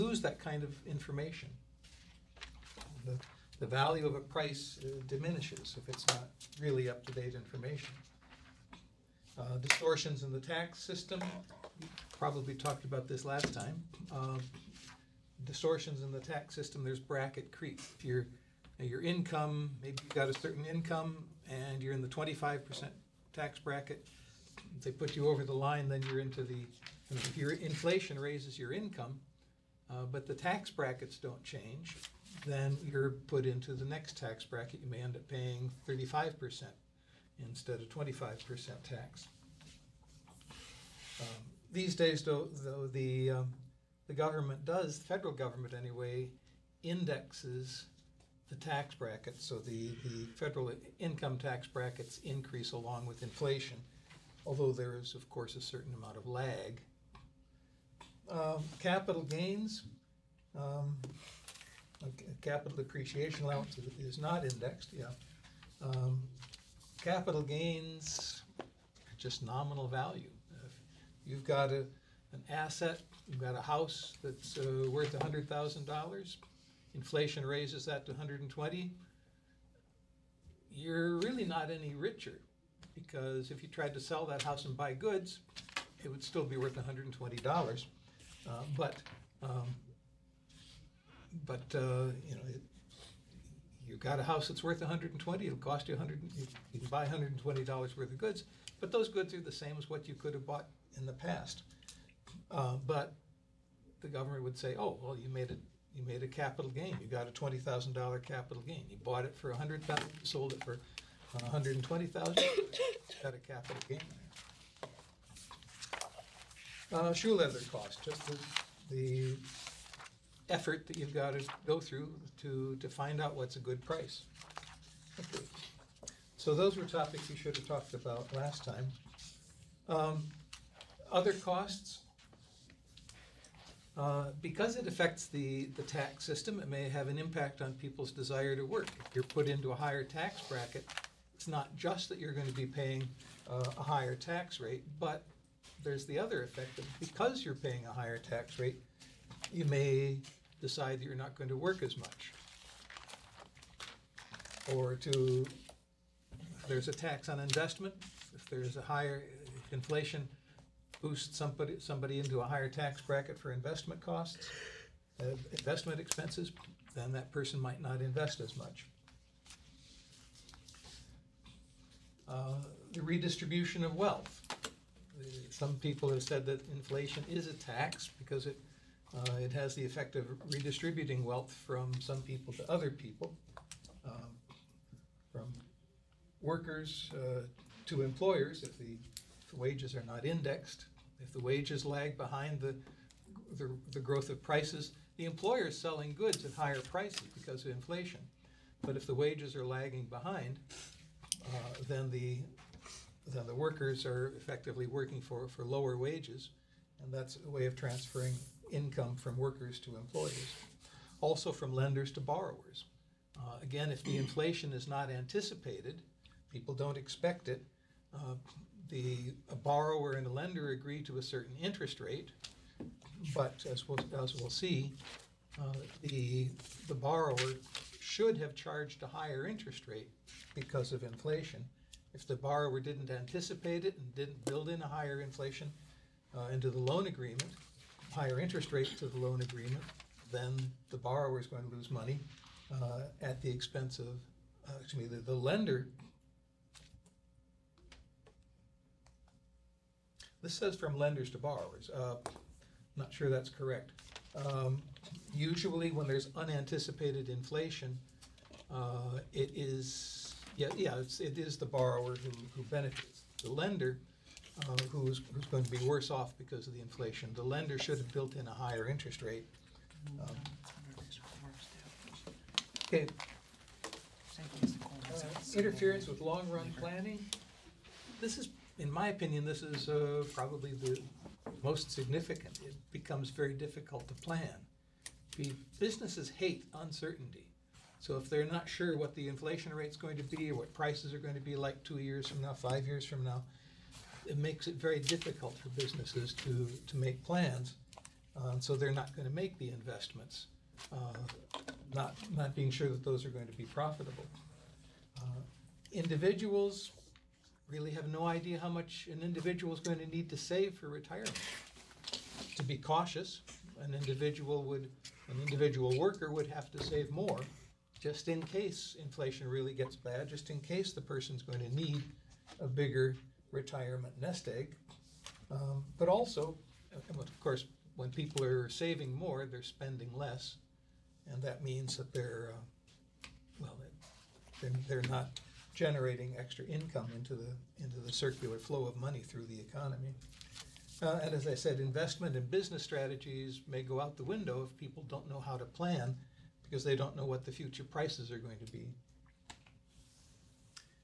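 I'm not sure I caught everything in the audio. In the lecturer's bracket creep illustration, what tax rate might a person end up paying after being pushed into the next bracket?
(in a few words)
35%.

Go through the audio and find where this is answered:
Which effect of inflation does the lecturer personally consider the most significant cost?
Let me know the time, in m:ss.
4:35.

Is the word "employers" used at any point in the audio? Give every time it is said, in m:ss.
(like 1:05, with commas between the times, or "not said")
3:08, 3:15, 3:29.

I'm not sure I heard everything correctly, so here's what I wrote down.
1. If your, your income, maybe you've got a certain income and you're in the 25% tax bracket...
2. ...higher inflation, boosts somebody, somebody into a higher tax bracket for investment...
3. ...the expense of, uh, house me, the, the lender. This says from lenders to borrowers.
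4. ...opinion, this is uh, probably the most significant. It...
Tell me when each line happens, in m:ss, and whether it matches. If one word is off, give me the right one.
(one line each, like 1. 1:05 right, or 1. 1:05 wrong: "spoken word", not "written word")
1. 0:17 right
2. 2:38 right
3. 4:03 wrong: "excuse", not "house"
4. 4:39 right.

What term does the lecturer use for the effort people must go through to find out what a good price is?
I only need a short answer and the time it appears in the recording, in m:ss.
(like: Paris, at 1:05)
shoe leather cost, at 1:57.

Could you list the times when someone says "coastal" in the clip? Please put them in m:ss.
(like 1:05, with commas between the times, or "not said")
not said.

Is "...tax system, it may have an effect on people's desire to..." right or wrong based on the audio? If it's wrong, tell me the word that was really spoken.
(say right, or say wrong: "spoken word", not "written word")
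wrong: "impact", not "effect".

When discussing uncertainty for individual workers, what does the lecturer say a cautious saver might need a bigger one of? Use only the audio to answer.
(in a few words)
retirement nest egg.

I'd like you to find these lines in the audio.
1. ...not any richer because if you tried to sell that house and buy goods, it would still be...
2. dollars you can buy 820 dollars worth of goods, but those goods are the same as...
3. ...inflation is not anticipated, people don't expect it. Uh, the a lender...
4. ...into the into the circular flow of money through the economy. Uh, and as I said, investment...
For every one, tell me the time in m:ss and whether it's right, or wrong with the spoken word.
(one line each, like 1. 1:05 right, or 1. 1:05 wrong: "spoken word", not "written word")
1. 1:21 right
2. 1:36 wrong: "120", not "820"
3. 3:34 wrong: "borrower", not "lender"
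4. 5:37 right.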